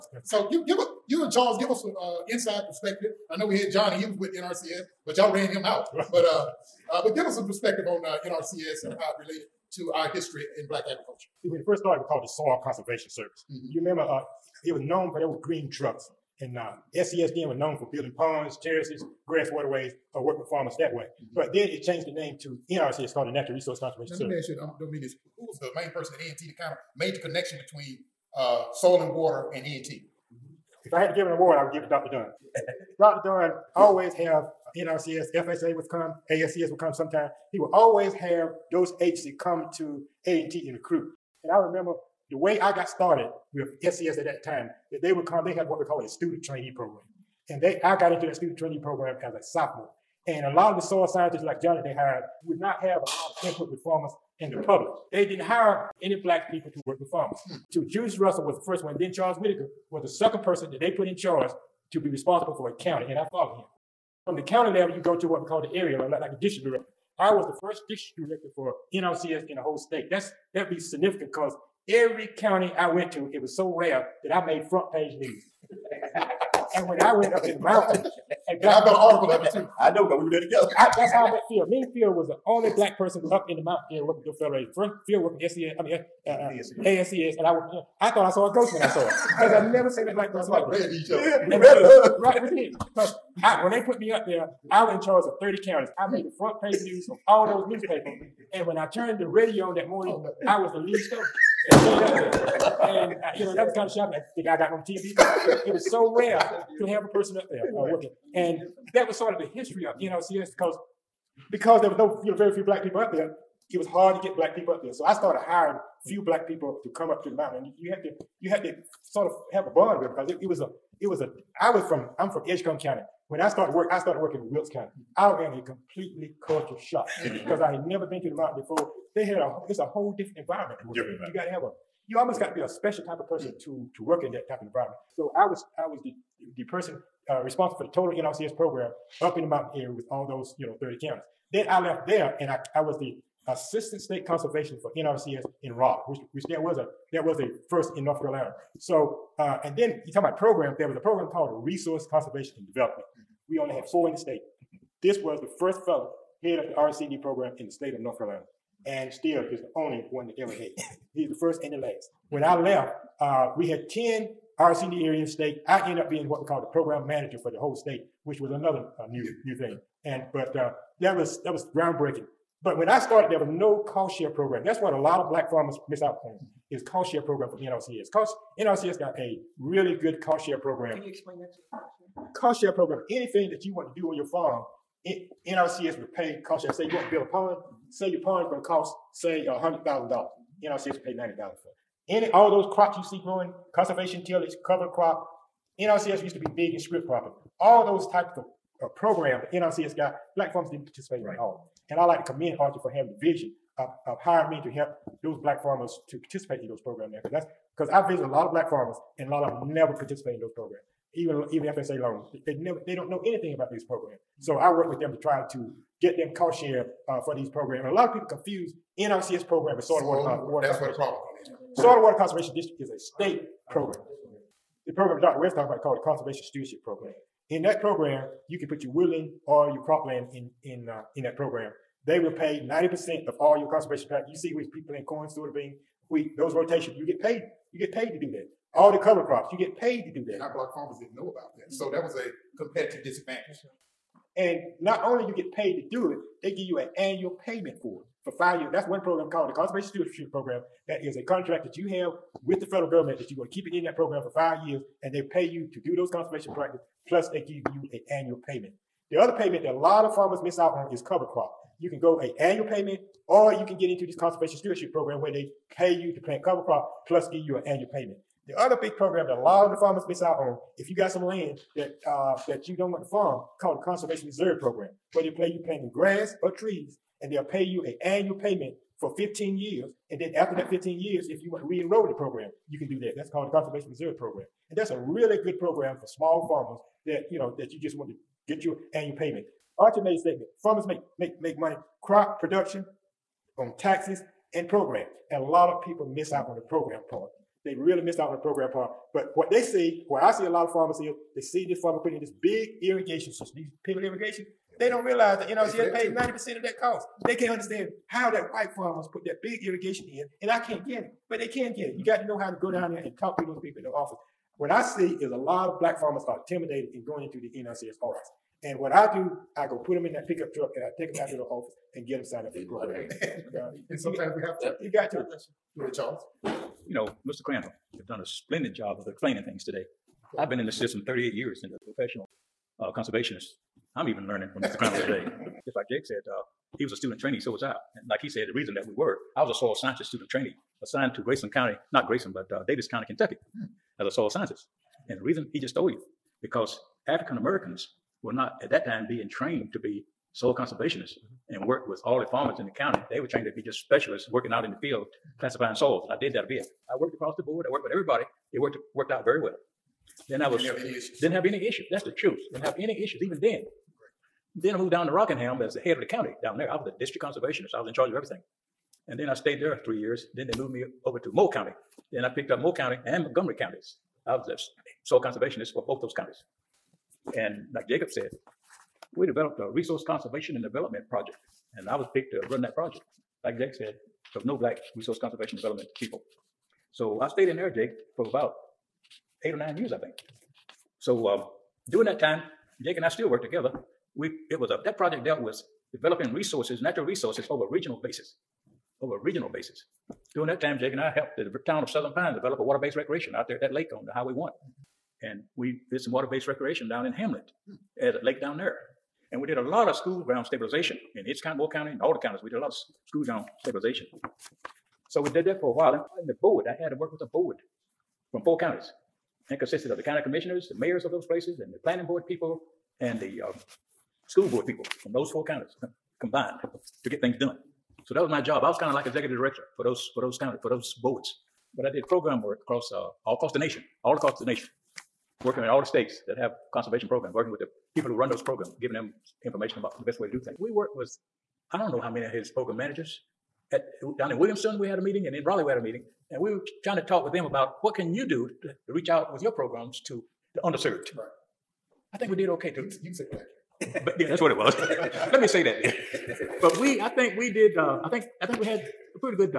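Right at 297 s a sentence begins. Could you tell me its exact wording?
They really miss out on the program part.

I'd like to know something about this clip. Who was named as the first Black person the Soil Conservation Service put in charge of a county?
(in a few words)
Julius Russell.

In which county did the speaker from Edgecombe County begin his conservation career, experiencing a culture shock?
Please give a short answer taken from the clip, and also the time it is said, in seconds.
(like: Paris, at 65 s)
Wilkes County, at 124 s.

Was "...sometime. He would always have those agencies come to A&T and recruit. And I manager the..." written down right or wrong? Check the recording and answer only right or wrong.
wrong.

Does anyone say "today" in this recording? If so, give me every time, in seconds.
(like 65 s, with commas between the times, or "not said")
329 s, 335 s.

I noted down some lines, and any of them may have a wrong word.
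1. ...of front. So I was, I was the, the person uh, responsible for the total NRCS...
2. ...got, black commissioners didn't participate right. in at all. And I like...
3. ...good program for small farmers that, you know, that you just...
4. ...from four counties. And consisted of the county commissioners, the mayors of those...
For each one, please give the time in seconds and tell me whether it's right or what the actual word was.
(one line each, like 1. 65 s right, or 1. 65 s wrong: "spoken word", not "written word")
1. 134 s wrong: "environment", not "front"
2. 199 s wrong: "farmers", not "commissioners"
3. 285 s right
4. 418 s right.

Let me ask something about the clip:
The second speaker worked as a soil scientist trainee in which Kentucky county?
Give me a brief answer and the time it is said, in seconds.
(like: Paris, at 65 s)
Davis County, at 342 s.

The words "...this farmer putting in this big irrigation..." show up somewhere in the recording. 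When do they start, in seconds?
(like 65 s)
301 s.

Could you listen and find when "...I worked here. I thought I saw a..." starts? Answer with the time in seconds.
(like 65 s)
87 s.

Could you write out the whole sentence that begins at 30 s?
If I had to give an award, I would give it to Dr.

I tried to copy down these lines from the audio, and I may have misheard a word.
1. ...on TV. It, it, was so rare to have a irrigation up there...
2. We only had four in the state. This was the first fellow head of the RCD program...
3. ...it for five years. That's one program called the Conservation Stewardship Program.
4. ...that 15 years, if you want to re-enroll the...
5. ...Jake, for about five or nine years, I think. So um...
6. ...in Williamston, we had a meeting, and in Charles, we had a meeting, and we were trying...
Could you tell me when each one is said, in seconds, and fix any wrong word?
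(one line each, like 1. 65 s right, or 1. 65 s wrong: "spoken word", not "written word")
1. 104 s wrong: "person", not "irrigation"
2. 153 s right
3. 248 s right
4. 280 s right
5. 387 s wrong: "eight", not "five"
6. 444 s wrong: "Raleigh", not "Charles".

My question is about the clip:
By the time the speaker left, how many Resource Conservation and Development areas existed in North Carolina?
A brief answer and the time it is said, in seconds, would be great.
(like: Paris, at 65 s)
10, at 163 s.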